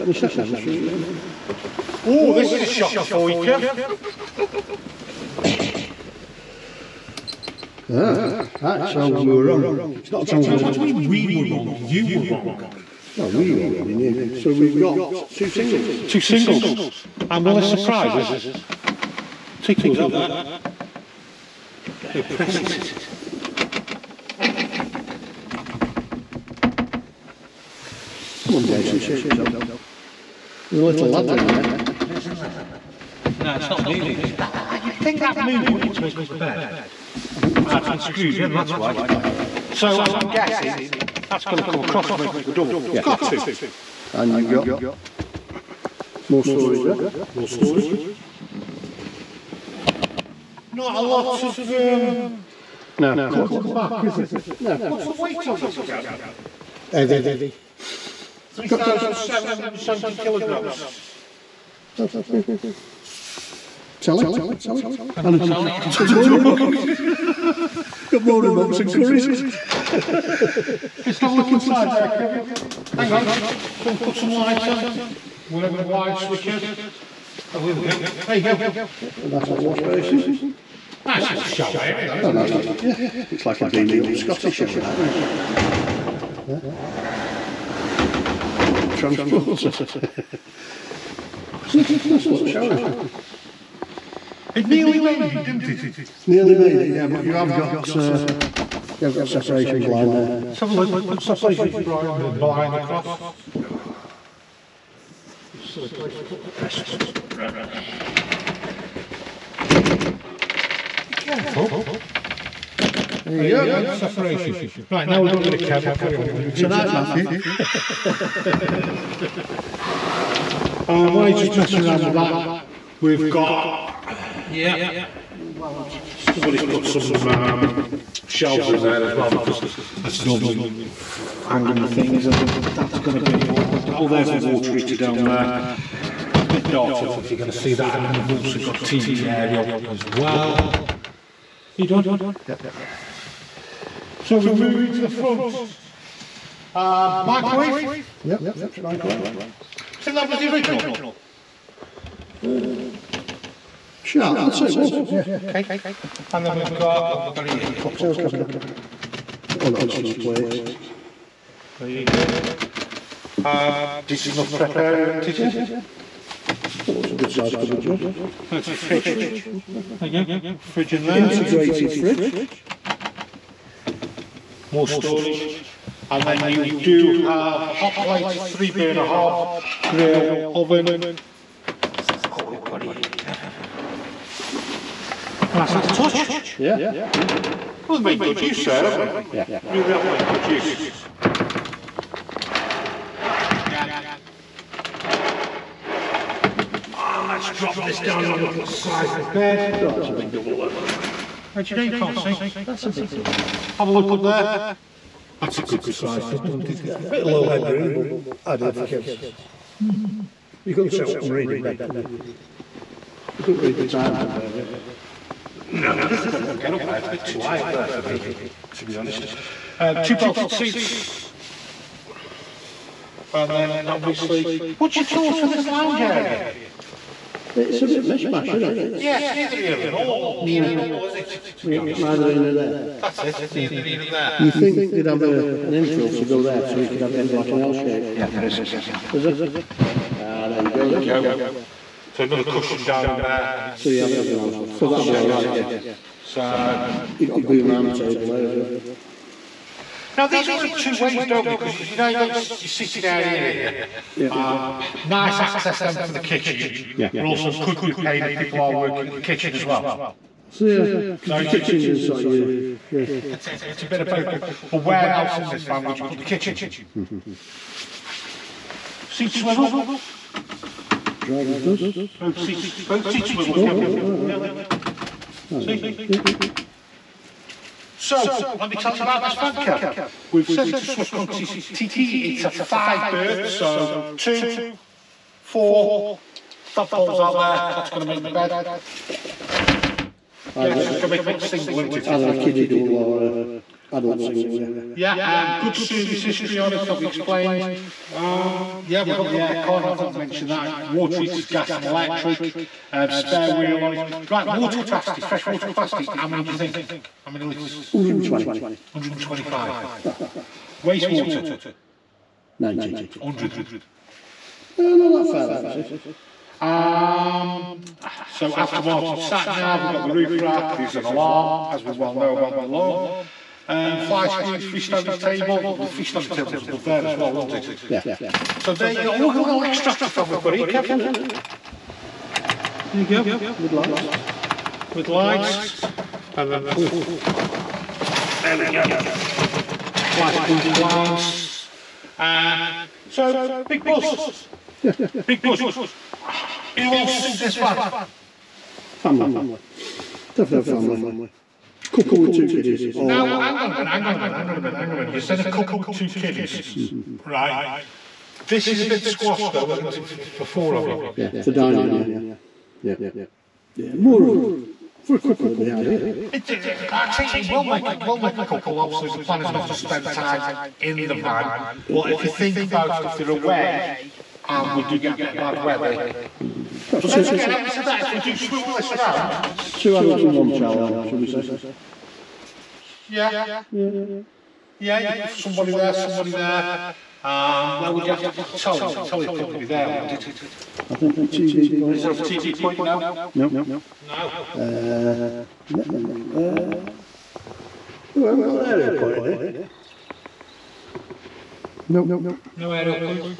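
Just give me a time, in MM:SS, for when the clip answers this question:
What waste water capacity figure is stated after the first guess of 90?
05:13.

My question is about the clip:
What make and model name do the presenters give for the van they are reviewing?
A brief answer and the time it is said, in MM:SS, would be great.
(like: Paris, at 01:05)
Swift Tiki, at 04:40.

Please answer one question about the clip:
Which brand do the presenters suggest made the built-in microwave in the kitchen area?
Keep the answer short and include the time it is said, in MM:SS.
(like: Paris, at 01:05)
Sharp, at 02:34.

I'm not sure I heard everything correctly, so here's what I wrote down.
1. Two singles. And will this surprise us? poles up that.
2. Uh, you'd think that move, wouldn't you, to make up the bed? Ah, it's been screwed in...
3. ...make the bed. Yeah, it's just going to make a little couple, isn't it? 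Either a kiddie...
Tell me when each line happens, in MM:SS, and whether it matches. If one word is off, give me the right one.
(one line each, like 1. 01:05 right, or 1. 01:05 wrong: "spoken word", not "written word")
1. 00:16 wrong: "tickles", not "poles"
2. 00:34 right
3. 04:48 wrong: "single", not "couple".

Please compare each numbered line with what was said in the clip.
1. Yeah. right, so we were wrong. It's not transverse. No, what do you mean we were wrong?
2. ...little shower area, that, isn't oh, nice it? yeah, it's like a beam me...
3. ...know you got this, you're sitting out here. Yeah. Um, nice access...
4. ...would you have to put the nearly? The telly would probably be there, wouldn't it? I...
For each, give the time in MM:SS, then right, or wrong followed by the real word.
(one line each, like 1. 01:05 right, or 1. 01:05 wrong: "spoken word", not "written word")
1. 00:07 right
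2. 01:21 right
3. 04:11 right
4. 06:27 wrong: "telly", not "nearly".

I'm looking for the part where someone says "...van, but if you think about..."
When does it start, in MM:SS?
06:11.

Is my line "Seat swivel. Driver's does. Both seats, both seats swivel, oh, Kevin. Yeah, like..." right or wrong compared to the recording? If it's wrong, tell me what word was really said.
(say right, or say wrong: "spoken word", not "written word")
right.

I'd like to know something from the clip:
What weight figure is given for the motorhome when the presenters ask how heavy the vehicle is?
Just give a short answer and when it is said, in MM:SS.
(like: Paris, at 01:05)
3,770 kilograms, at 00:58.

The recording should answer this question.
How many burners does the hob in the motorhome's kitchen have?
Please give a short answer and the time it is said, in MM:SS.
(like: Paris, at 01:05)
Three, at 02:58.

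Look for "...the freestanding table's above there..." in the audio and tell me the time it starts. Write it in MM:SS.
05:25.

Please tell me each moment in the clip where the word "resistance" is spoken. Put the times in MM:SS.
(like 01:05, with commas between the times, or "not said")
not said.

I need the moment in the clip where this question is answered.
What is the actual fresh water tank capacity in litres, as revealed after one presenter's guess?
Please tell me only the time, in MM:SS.
05:08.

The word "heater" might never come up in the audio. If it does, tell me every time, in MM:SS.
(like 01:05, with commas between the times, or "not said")
02:14, 05:01.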